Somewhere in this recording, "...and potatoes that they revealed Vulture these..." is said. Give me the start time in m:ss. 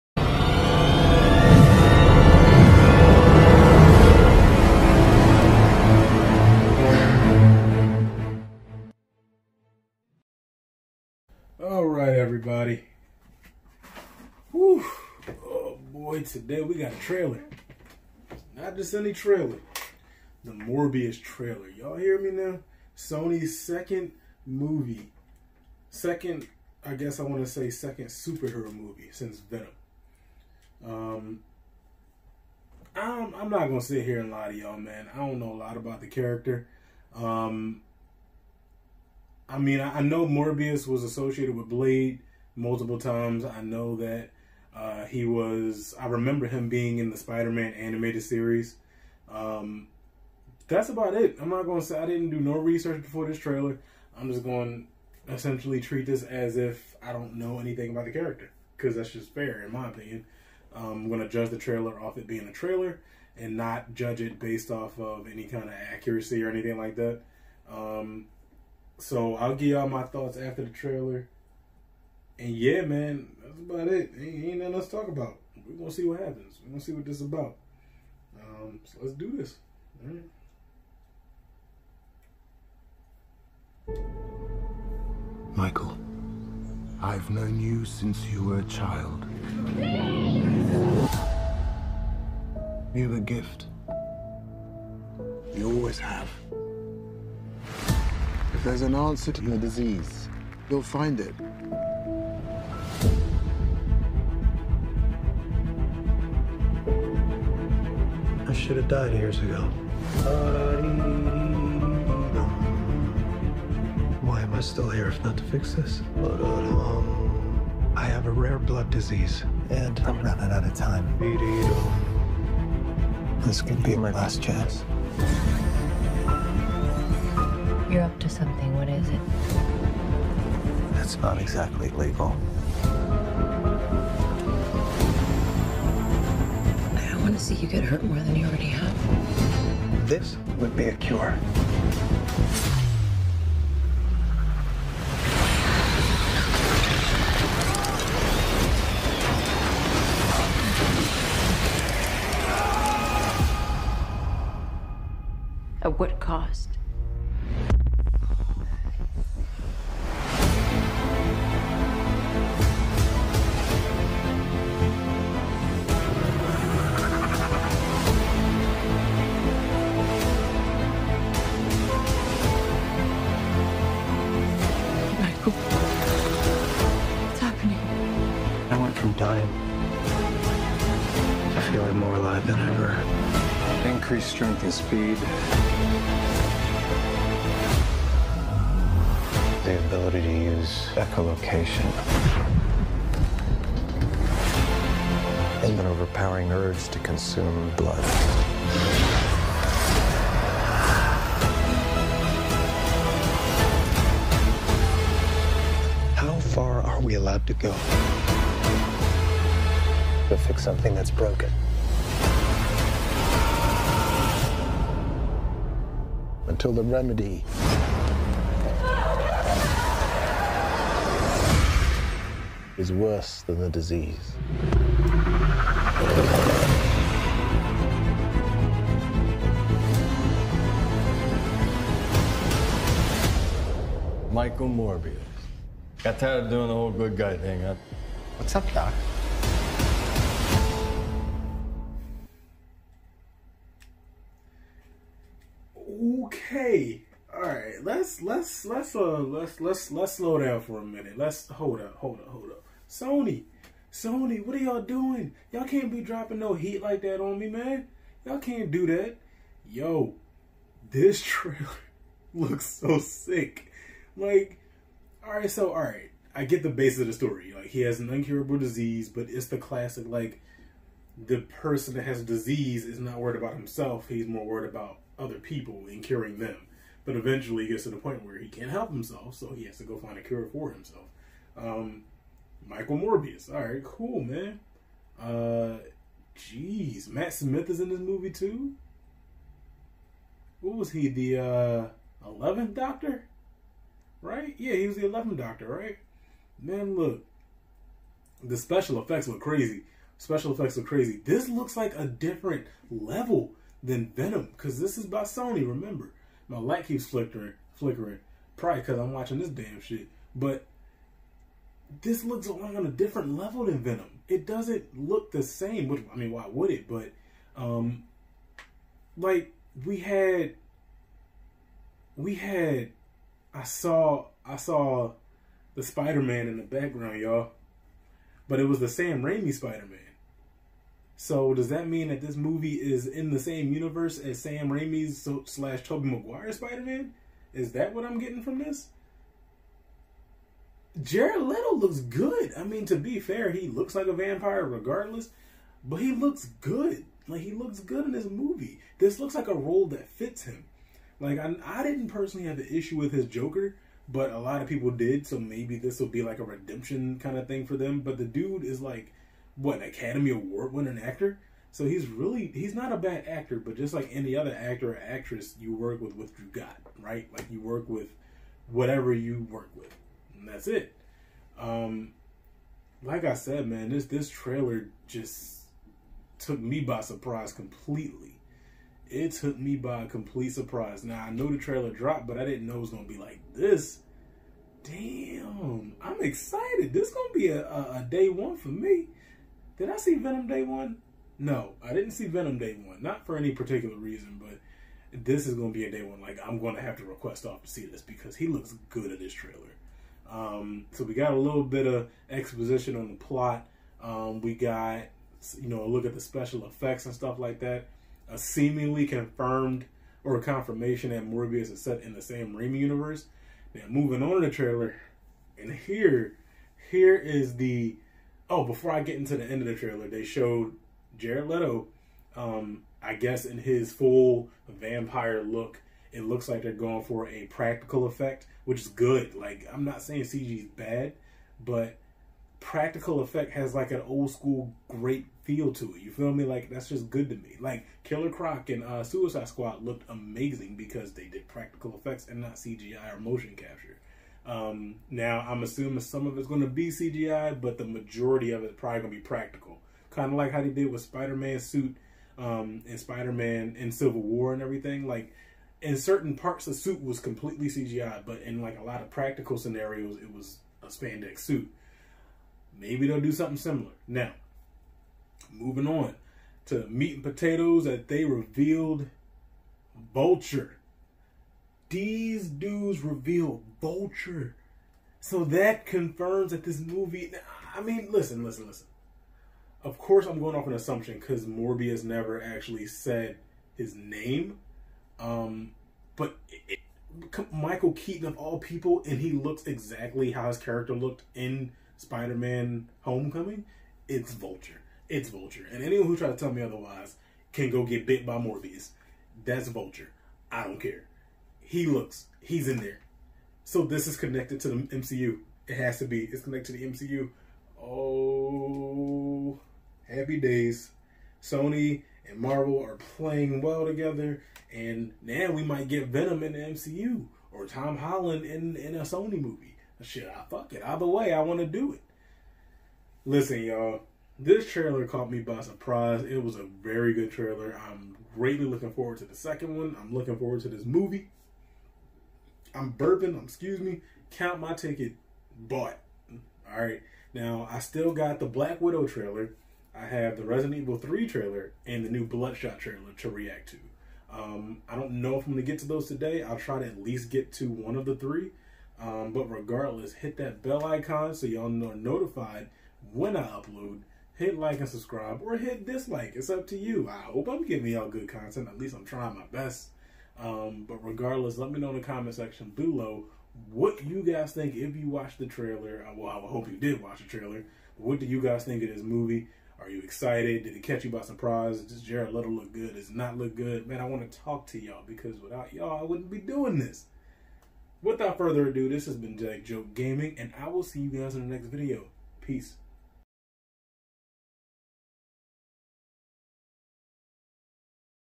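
7:47.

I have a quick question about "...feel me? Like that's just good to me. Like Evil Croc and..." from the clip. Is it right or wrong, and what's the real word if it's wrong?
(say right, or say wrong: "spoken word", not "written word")
wrong: "Killer", not "Evil".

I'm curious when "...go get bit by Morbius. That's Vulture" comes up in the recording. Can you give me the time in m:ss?
8:17.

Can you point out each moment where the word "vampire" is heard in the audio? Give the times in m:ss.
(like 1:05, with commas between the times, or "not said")
5:44, 7:04.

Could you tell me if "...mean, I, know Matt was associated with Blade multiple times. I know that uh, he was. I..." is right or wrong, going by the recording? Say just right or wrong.
wrong.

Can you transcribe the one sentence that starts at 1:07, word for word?
Um, so I'll give y'all my thoughts after the trailer.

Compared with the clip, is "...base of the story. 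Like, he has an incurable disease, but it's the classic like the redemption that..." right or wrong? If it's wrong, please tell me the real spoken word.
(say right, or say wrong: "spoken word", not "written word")
wrong: "person", not "redemption".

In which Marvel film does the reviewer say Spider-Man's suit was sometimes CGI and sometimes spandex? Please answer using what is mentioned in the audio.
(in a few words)
Civil War.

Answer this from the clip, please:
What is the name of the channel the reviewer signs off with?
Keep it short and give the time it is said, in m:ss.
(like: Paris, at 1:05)
Jack Joke Gaming, at 9:39.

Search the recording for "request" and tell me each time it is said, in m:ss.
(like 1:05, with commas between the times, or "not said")
6:37.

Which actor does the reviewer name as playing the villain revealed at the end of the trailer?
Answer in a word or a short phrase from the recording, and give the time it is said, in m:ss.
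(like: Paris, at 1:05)
Michael Keaton, at 8:07.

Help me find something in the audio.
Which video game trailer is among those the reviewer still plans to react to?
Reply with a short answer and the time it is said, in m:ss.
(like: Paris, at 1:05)
Resident Evil 3, at 9:00.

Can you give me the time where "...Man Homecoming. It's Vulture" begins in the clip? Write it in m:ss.
8:12.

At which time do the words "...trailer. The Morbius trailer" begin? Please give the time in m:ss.
0:19.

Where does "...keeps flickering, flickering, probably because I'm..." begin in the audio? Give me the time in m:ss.
5:06.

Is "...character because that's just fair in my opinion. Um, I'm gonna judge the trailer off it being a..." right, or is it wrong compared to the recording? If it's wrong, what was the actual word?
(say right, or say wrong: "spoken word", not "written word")
right.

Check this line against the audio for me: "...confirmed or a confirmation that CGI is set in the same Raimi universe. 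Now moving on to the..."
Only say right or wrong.
wrong.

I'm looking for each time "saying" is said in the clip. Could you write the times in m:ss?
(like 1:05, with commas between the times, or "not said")
7:10.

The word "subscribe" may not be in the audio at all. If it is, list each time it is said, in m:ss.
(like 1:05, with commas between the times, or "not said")
9:14.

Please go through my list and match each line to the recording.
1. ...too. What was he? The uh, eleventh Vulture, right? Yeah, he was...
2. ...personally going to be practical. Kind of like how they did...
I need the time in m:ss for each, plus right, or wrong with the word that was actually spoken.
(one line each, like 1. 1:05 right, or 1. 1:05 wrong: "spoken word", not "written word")
1. 4:48 wrong: "Doctor", not "Vulture"
2. 7:28 wrong: "probably", not "personally".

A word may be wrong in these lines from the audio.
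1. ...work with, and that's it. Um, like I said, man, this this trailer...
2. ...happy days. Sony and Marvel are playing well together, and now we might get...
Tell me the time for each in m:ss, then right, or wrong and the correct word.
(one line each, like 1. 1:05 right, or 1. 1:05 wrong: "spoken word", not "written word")
1. 6:09 right
2. 8:30 right.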